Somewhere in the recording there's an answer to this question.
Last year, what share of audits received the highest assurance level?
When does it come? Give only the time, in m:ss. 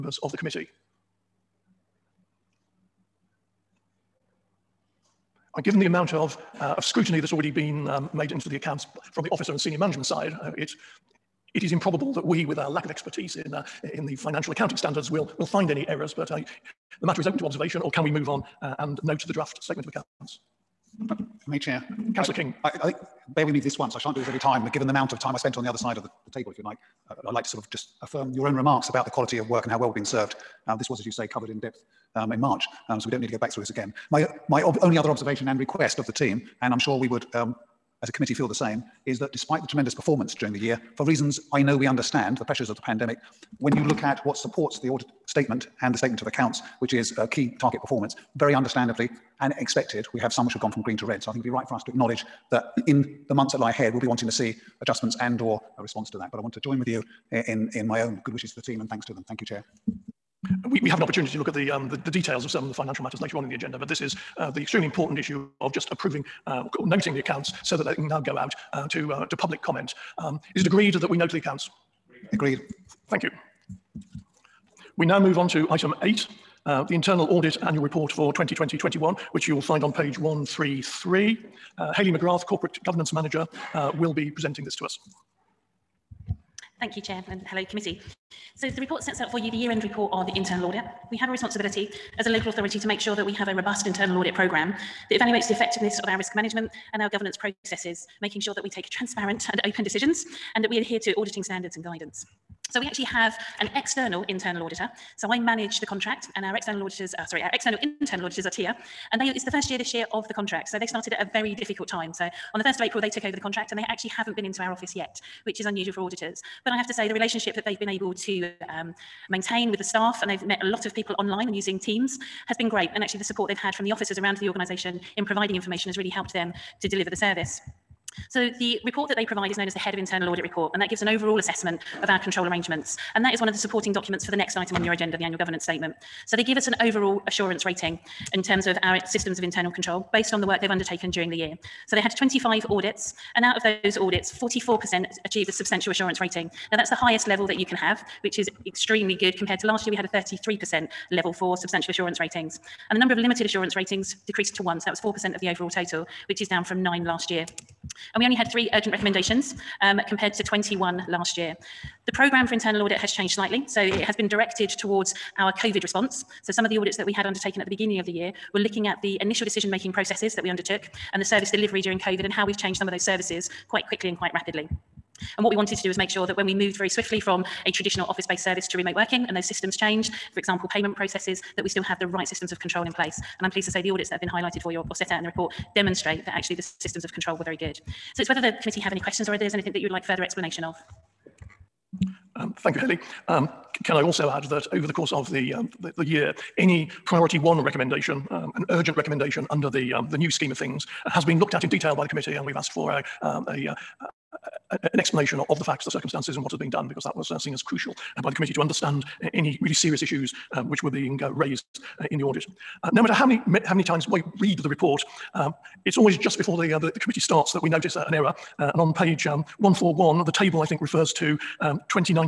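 2:30.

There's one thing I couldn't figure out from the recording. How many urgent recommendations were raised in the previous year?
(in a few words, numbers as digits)
21.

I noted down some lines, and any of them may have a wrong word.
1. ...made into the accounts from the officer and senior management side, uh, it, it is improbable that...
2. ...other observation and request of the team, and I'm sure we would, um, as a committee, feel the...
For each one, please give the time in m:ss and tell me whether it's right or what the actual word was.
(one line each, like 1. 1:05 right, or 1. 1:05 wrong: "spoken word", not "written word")
1. 0:08 right
2. 0:34 right.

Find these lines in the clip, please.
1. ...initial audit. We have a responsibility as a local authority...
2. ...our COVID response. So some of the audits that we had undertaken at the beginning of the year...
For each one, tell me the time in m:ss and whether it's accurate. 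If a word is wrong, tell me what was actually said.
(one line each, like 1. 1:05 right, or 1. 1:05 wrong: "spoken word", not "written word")
1. 1:30 wrong: "internal", not "initial"
2. 2:45 right.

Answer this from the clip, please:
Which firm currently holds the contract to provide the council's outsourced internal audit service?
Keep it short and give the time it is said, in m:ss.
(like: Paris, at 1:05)
TIAA, at 1:48.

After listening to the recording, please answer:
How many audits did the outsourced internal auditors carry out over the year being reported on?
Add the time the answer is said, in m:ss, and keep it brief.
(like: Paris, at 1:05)
25, at 2:22.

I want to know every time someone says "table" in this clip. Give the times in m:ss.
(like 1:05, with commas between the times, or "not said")
0:26, 3:40.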